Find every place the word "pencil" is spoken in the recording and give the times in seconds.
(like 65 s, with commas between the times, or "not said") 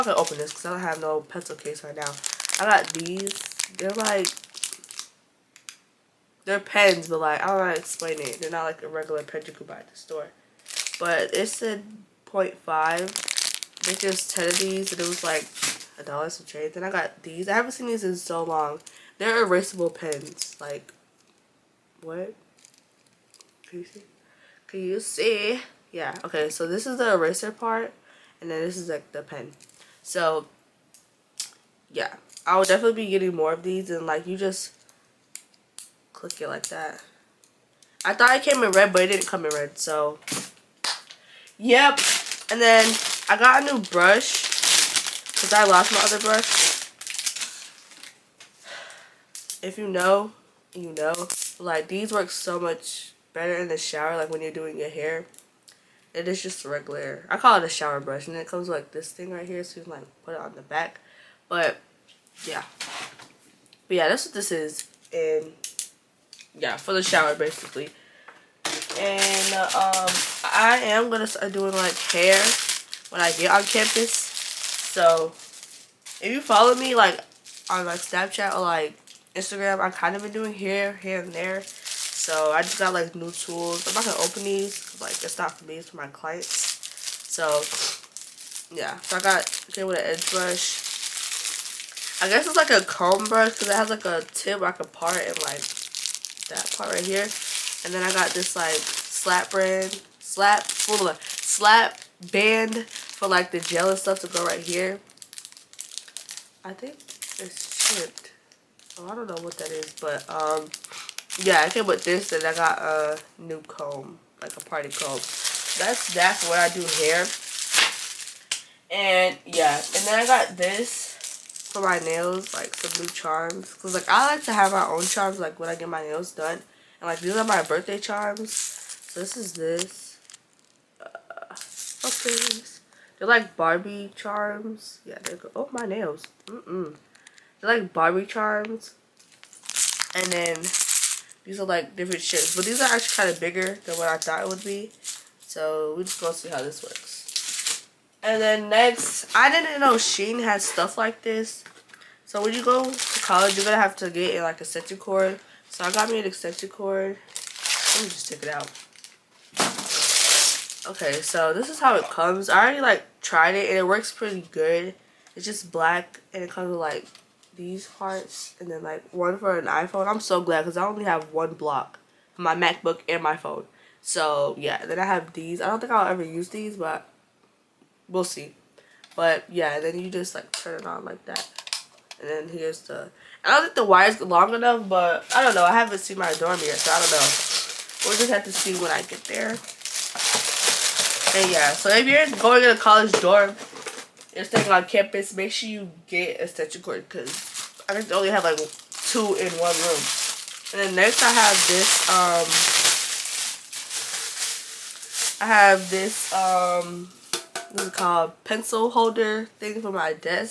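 1 s, 208 s.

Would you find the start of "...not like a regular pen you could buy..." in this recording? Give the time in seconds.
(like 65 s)
8 s.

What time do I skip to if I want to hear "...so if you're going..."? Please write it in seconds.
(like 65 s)
191 s.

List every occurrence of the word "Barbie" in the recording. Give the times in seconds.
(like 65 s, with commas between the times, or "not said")
133 s, 137 s.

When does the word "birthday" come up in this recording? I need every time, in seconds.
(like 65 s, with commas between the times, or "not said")
127 s.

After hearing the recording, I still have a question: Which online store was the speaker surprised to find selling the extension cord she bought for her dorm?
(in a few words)
Shein.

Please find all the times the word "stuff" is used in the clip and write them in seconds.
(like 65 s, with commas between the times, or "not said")
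103 s, 150 s.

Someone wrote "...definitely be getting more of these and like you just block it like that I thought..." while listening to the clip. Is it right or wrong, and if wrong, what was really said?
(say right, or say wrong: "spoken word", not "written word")
wrong: "click", not "block".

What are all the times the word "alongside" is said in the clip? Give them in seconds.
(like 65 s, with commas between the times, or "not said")
not said.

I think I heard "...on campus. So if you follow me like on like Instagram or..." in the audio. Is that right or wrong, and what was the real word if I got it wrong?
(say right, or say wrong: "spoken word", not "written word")
wrong: "Snapchat", not "Instagram".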